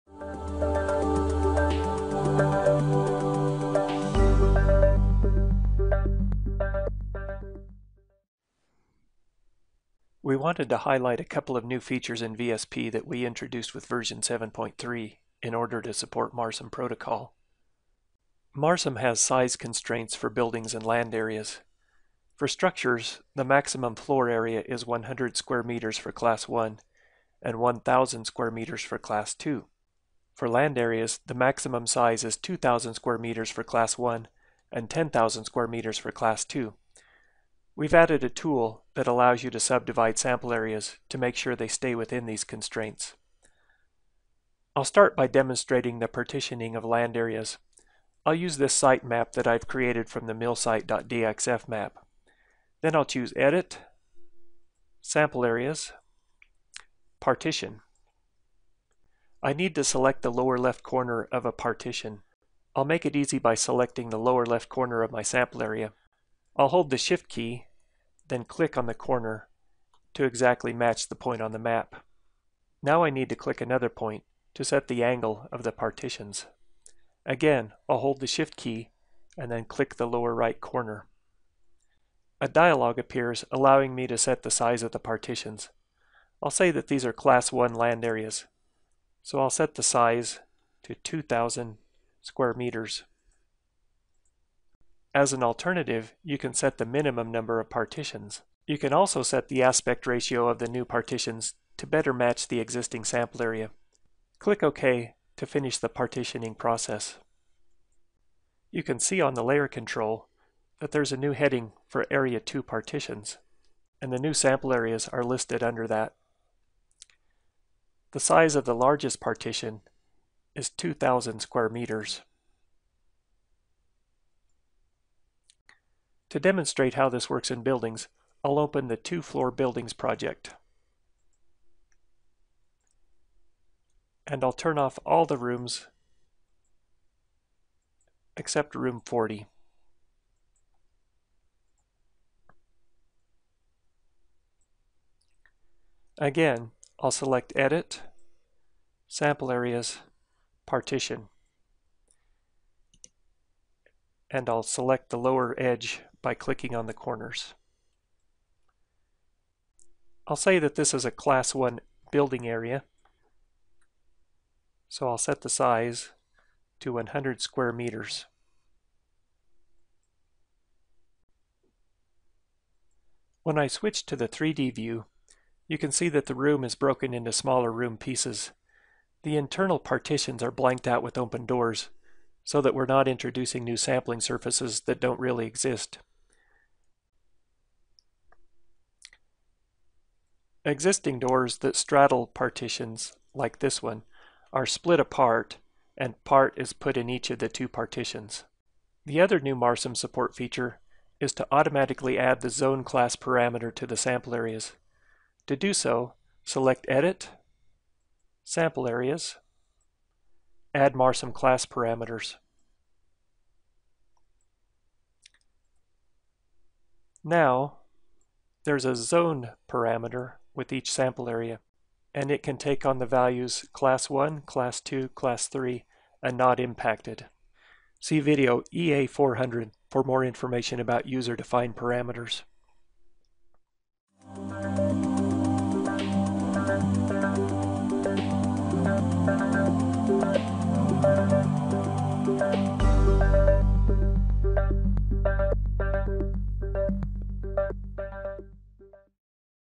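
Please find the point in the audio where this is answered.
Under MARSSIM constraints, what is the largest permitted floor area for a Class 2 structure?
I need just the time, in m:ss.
0:27.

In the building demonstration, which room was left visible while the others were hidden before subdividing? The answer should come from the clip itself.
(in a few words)
Room 40.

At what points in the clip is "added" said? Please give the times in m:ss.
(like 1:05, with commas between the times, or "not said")
0:37.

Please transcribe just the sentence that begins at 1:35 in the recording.
As an alternative, you can set the minimum number of partitions.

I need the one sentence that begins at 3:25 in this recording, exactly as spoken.
To do so, select Edit, Sample Areas, Add MARSSIM class parameters.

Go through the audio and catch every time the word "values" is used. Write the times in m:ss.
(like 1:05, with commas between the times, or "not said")
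3:43.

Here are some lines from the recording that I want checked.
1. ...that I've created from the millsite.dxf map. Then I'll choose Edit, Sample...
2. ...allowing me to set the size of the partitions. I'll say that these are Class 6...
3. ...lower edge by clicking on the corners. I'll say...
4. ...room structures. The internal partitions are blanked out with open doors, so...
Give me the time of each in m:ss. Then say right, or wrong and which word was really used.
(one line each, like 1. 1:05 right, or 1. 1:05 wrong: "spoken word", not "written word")
1. 0:49 right
2. 1:23 wrong: "1", not "6"
3. 2:35 right
4. 2:57 wrong: "pieces", not "structures".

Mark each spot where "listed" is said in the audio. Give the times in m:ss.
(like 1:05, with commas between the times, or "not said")
1:55.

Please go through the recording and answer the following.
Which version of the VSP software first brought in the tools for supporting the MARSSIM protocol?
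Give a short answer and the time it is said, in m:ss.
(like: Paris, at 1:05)
7.3, at 0:13.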